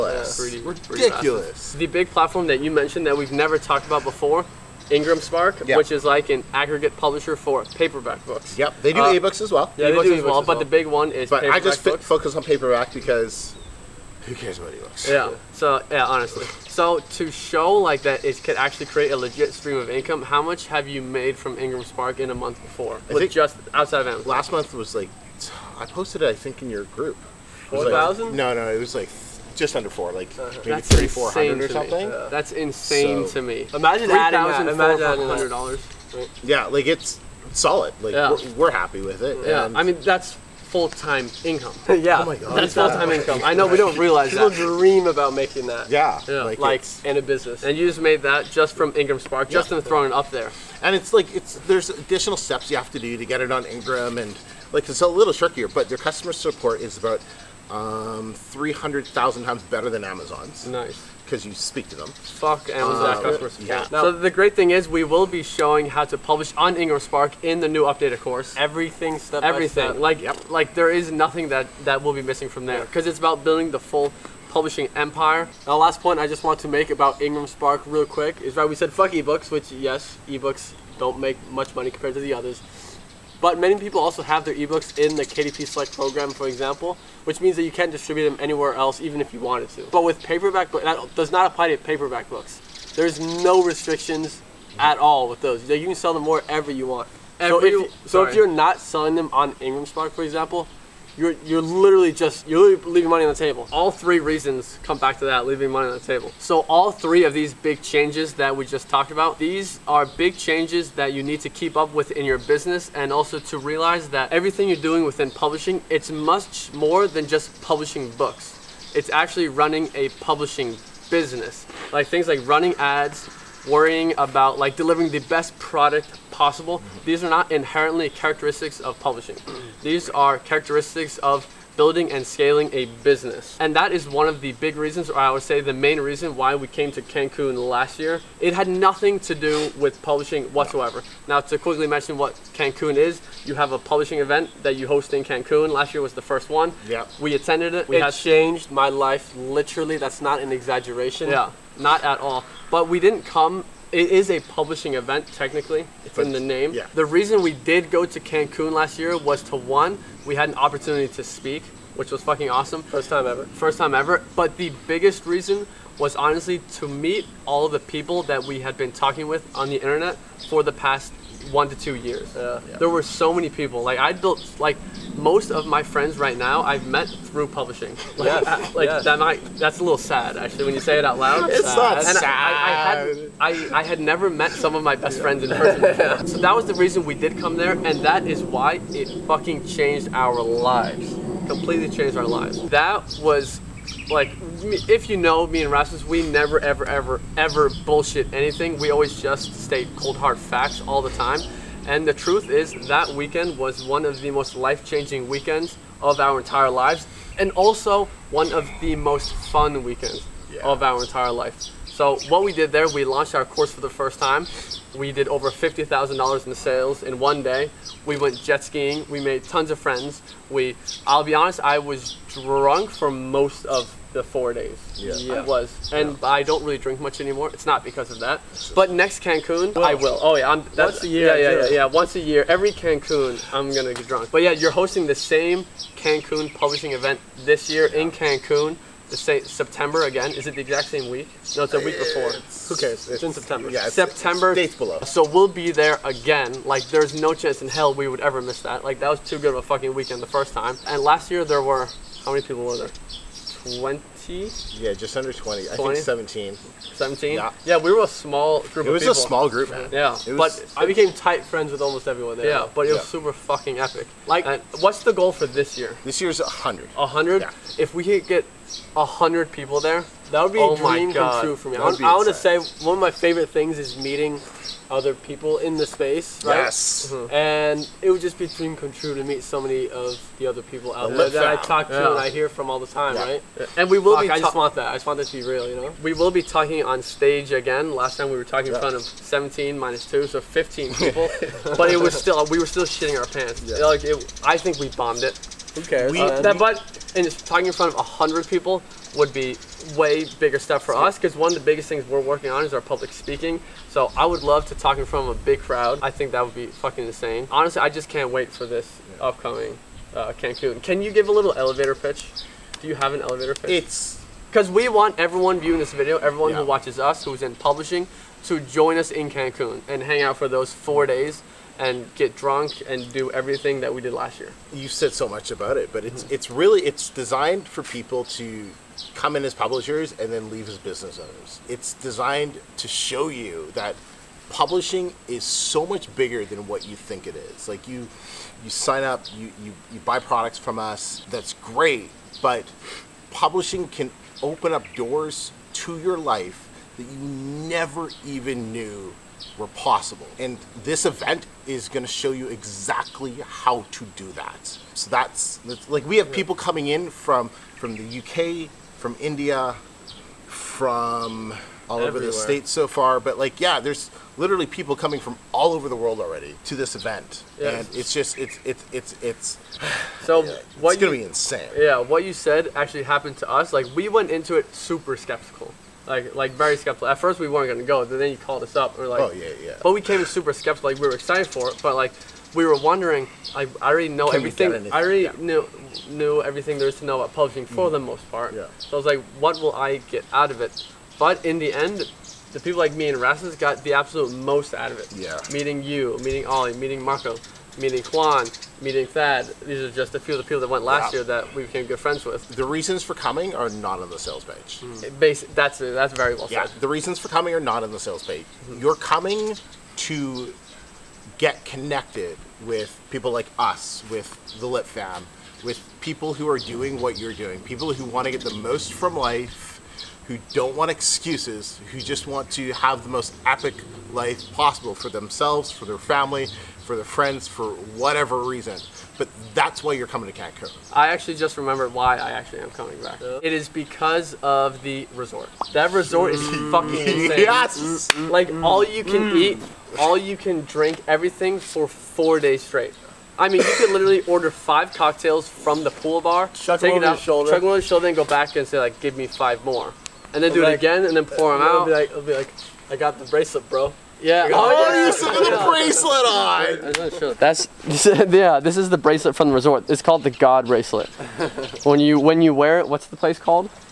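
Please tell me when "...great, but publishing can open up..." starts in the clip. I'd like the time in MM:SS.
05:41.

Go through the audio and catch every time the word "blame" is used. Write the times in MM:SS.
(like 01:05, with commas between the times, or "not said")
not said.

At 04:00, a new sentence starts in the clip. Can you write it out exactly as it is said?
Is it the exact same week?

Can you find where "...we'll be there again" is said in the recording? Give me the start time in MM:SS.
04:05.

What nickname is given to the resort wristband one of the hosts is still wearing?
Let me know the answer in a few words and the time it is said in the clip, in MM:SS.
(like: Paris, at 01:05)
God bracelet, at 07:40.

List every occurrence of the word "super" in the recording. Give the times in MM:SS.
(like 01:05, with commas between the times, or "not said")
04:23, 06:14, 06:20.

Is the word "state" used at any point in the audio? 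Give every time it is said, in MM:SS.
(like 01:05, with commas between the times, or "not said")
03:19, 06:02.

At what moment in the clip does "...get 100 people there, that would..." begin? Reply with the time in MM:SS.
04:28.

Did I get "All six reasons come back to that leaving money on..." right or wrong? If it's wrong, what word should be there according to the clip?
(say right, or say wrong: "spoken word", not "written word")
wrong: "three", not "six".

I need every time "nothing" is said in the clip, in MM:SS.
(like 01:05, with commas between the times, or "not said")
01:11, 02:18.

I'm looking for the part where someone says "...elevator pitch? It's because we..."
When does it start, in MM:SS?
05:13.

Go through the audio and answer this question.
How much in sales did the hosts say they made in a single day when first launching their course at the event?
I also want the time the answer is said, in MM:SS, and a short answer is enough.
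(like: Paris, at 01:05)
$50,000, at 03:35.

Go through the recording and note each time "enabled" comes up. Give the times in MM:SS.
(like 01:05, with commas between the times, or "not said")
not said.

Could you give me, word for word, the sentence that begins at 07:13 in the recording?
It is because of the resort.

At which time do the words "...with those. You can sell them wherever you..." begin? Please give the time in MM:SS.
01:35.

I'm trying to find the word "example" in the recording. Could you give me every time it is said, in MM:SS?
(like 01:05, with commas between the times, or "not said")
01:26, 01:40.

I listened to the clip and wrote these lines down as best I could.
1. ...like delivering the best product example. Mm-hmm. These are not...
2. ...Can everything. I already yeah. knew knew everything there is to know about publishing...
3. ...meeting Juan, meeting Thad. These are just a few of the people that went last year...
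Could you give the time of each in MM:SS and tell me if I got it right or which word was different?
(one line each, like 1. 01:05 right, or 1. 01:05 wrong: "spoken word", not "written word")
1. 02:04 wrong: "possible", not "example"
2. 06:24 right
3. 06:37 right.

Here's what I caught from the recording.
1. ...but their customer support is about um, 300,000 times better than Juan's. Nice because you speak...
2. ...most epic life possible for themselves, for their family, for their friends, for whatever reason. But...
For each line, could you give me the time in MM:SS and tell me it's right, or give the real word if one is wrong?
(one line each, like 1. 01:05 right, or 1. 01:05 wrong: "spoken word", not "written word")
1. 00:55 wrong: "Amazon", not "Juan"
2. 07:03 right.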